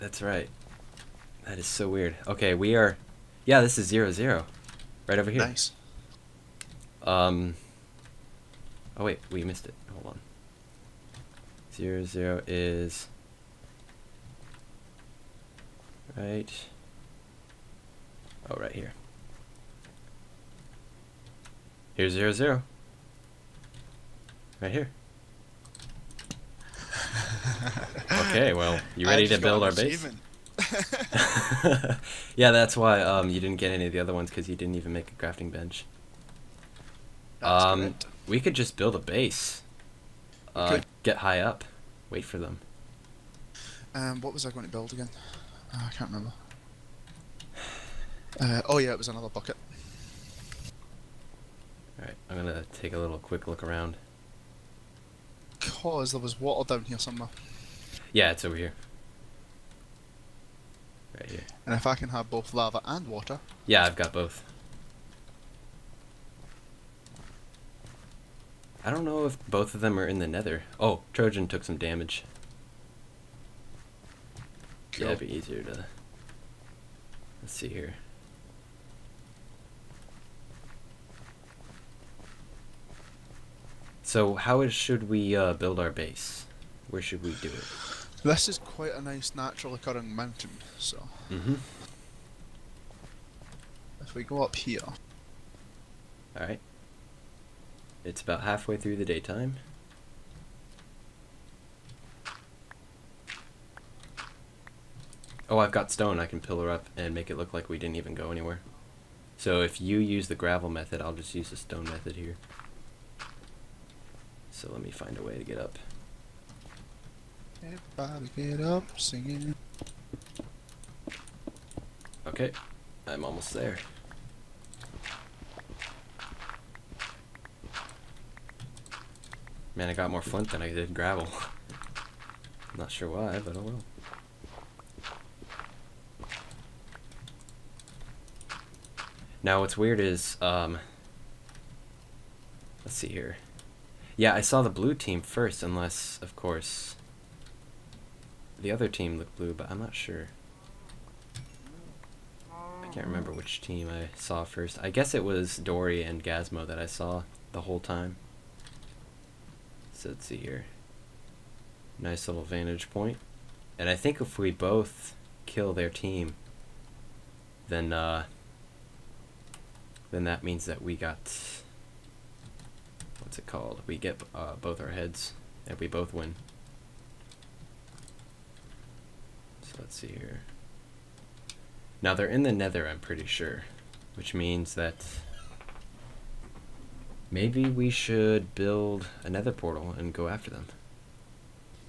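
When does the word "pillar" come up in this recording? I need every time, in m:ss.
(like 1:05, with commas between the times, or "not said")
1:46.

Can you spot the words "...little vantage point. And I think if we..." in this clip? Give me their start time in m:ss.
2:42.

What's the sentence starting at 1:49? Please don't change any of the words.
So if you use the gravel method, I'll just use the stone method here.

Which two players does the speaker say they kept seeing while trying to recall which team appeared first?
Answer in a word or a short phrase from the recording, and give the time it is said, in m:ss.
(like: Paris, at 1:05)
Dori and Gazmo, at 2:35.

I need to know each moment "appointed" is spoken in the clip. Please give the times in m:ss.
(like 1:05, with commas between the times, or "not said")
not said.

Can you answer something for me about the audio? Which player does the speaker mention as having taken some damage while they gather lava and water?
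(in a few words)
Trojan.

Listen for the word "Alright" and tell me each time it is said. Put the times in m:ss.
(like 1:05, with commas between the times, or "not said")
0:51, 1:36.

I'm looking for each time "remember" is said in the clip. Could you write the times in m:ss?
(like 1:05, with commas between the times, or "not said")
0:46, 2:33.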